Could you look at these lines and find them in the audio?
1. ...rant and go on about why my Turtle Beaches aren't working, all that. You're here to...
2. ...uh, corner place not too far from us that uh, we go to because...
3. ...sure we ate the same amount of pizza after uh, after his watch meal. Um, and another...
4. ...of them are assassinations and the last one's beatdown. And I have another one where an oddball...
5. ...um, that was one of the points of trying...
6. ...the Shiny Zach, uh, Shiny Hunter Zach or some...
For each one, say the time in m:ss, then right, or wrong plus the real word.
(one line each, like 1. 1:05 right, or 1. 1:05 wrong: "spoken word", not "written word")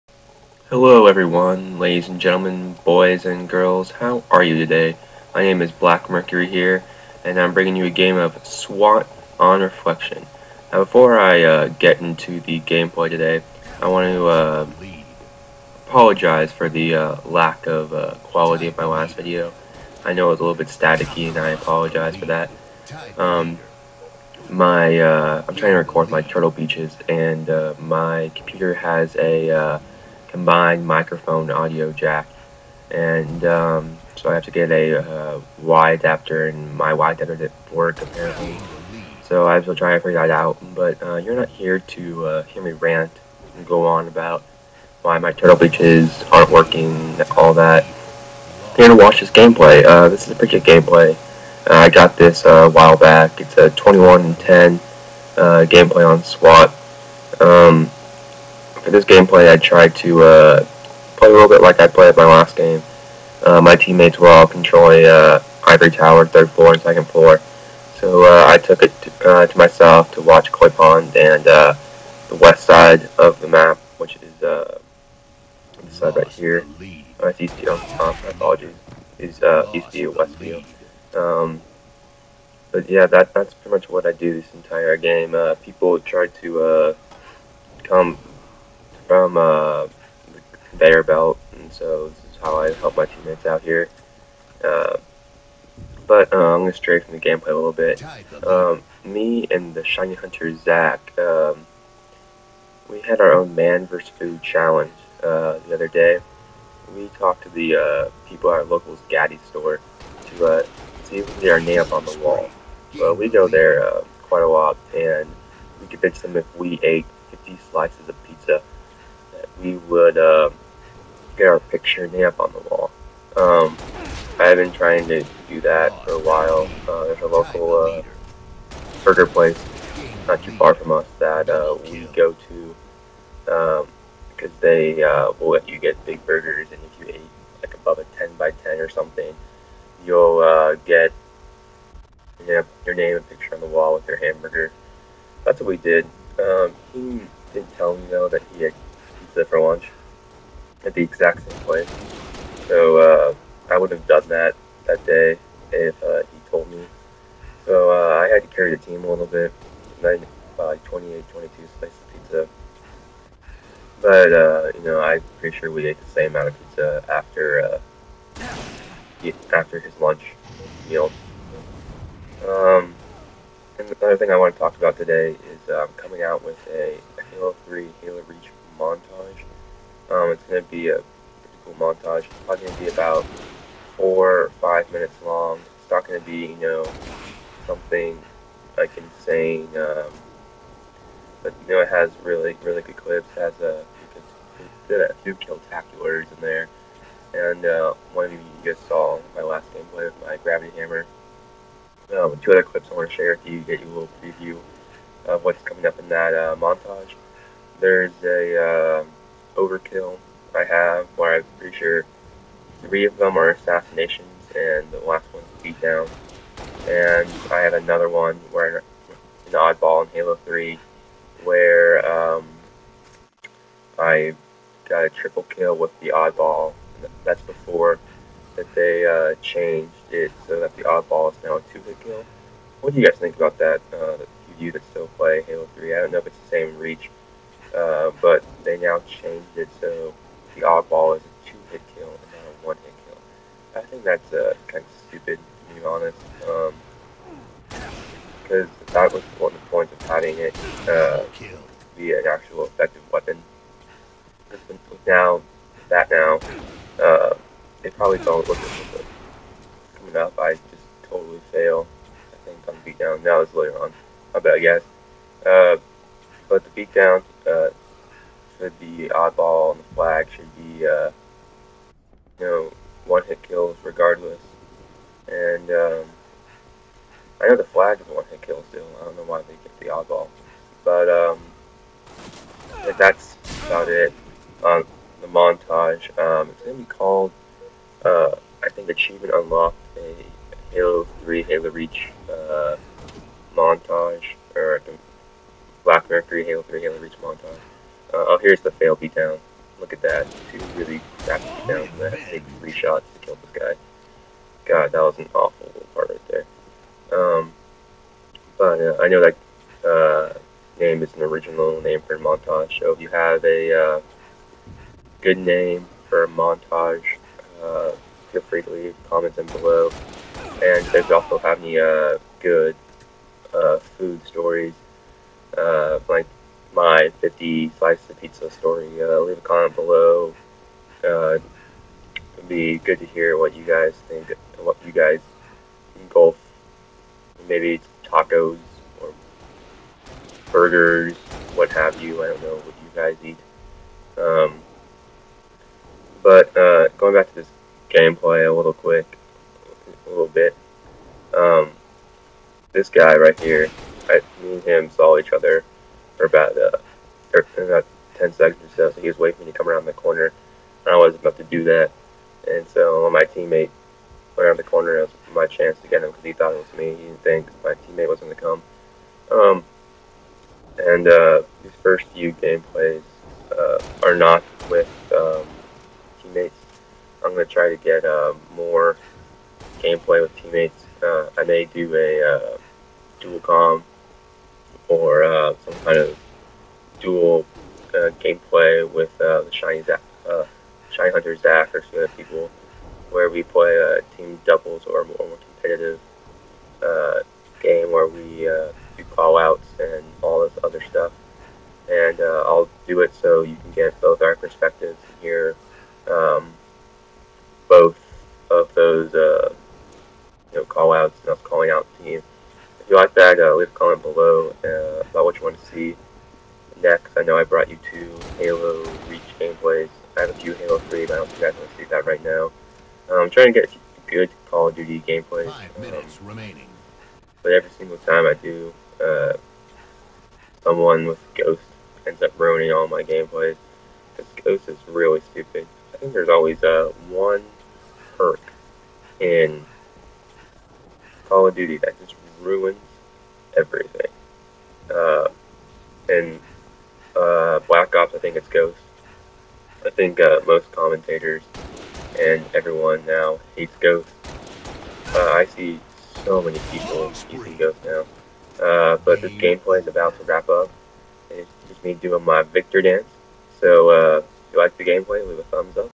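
1. 0:42 right
2. 2:07 wrong: "burger", not "corner"
3. 2:45 wrong: "lunch", not "watch"
4. 3:33 right
5. 4:08 wrong: "having", not "trying"
6. 6:29 right.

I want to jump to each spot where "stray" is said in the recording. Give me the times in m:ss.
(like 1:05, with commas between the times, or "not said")
1:36.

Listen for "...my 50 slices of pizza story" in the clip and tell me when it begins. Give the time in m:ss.
5:26.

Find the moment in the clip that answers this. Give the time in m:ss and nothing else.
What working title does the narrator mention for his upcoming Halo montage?
4:48.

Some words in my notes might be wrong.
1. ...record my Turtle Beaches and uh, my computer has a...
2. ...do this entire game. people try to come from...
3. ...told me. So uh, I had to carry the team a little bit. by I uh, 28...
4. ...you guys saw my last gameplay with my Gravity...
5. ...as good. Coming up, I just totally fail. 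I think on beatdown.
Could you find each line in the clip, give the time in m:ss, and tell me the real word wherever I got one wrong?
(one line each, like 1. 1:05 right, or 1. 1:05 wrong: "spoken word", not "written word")
1. 0:25 right
2. 1:24 right
3. 2:36 right
4. 3:18 right
5. 4:18 right.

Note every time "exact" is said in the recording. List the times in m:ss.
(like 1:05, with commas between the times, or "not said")
2:31.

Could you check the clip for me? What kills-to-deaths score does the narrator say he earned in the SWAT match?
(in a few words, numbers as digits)
21 and 10.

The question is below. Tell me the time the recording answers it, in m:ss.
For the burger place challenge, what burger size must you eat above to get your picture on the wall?
2:18.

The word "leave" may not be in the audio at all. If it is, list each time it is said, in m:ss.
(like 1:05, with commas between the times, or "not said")
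5:18, 5:29, 6:53, 7:45.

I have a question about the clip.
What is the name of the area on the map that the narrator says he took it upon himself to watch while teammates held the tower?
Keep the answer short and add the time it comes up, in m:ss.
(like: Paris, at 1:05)
Koi Pond, at 1:10.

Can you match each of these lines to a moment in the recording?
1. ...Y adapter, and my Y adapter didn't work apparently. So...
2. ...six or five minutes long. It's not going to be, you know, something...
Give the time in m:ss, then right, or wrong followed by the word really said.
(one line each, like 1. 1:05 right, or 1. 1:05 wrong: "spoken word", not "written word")
1. 0:35 right
2. 3:03 wrong: "four", not "six".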